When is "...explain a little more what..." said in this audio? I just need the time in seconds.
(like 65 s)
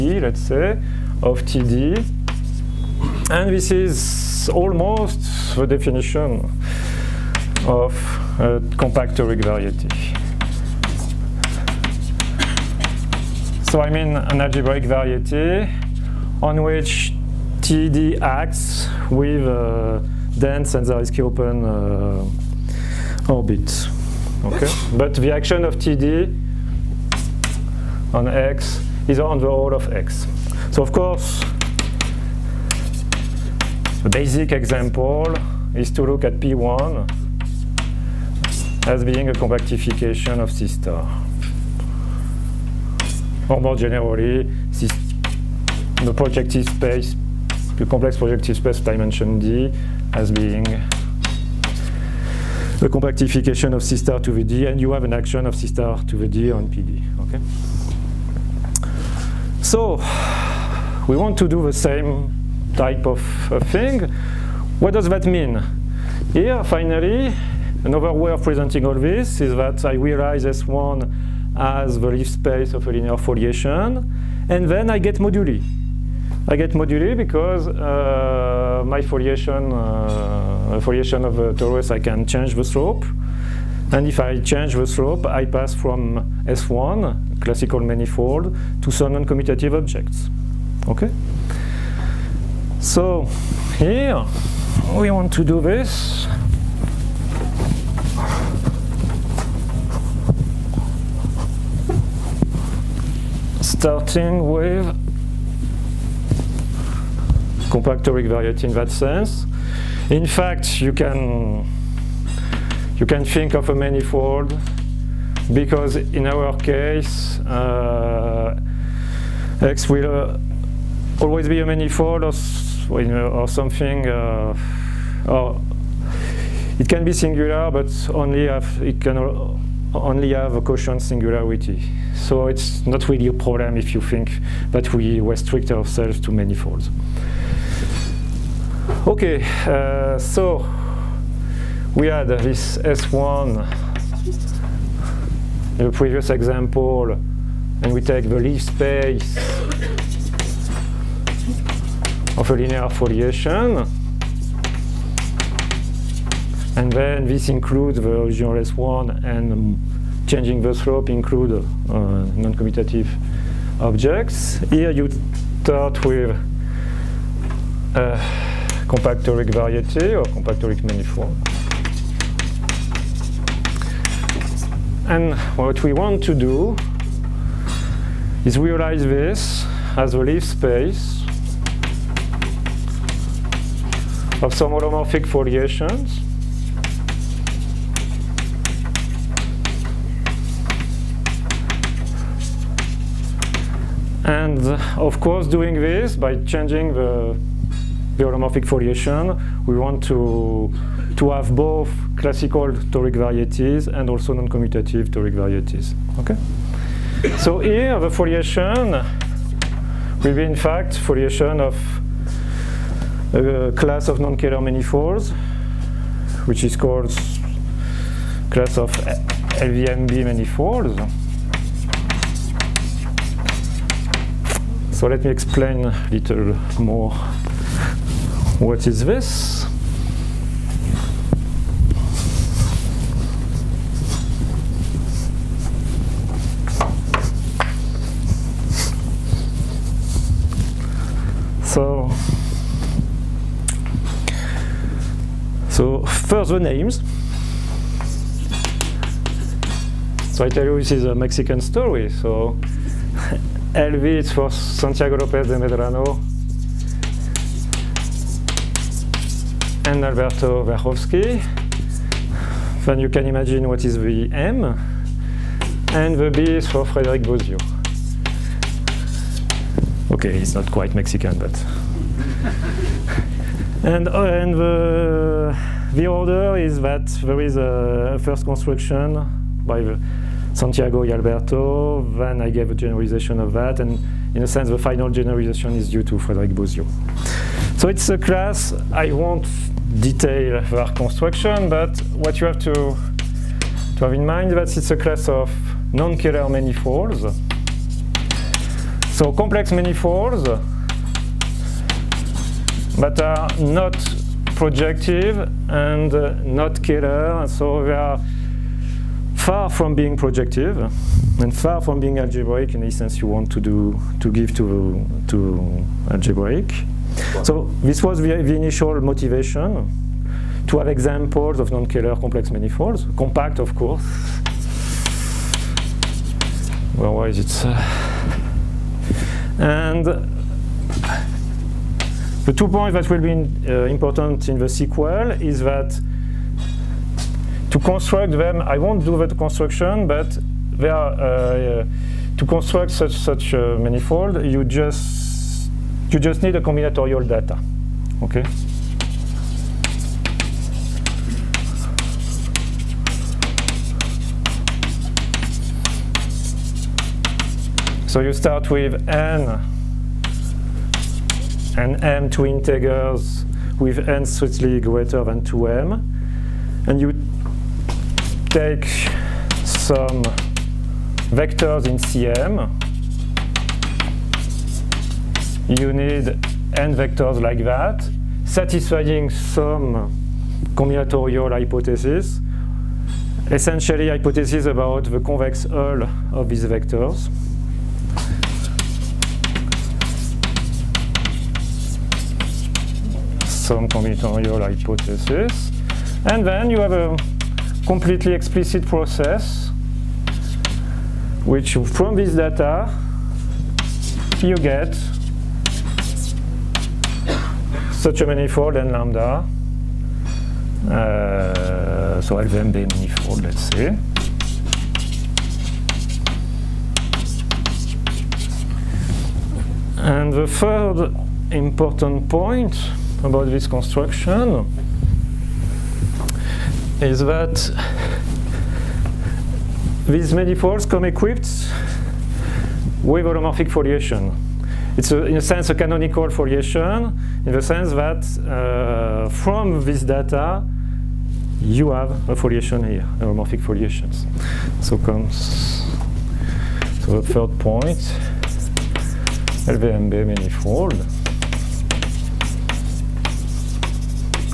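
225 s.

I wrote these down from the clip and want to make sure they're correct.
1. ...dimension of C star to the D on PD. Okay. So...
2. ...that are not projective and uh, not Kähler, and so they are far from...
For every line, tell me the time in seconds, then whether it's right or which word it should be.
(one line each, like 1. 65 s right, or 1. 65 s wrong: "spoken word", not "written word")
1. 55 s wrong: "action", not "dimension"
2. 302 s right.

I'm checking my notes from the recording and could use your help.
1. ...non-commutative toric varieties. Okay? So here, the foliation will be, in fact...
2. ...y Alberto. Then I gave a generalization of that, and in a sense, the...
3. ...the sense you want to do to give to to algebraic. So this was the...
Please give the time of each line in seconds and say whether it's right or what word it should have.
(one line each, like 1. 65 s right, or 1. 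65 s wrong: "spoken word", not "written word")
1. 204 s right
2. 281 s right
3. 312 s right.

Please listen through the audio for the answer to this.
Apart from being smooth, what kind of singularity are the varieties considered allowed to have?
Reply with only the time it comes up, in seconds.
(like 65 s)
130 s.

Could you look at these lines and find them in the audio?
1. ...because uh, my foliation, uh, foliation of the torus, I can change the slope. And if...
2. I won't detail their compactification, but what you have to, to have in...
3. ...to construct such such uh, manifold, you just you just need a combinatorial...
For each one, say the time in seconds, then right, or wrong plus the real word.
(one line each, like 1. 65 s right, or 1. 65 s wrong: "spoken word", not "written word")
1. 77 s right
2. 288 s wrong: "construction", not "compactification"
3. 342 s right.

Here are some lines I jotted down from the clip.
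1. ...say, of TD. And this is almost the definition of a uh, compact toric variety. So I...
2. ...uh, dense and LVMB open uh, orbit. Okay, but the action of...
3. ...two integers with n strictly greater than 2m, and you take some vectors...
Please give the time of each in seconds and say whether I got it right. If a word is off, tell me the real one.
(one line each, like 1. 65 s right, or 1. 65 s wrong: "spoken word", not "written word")
1. 0 s right
2. 20 s wrong: "Zariski", not "LVMB"
3. 362 s right.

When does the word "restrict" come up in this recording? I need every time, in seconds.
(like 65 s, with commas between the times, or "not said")
135 s.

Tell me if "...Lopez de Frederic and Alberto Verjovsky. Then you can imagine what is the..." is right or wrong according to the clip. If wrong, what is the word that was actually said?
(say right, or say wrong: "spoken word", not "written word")
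wrong: "Medrano", not "Frederic".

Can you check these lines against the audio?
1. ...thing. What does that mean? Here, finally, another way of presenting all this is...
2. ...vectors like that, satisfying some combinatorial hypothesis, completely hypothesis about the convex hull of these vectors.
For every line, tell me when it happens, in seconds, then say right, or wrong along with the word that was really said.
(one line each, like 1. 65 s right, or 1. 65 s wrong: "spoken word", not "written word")
1. 63 s right
2. 376 s wrong: "essentially", not "completely".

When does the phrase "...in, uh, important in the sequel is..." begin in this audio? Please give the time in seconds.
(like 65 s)
333 s.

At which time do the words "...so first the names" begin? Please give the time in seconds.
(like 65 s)
245 s.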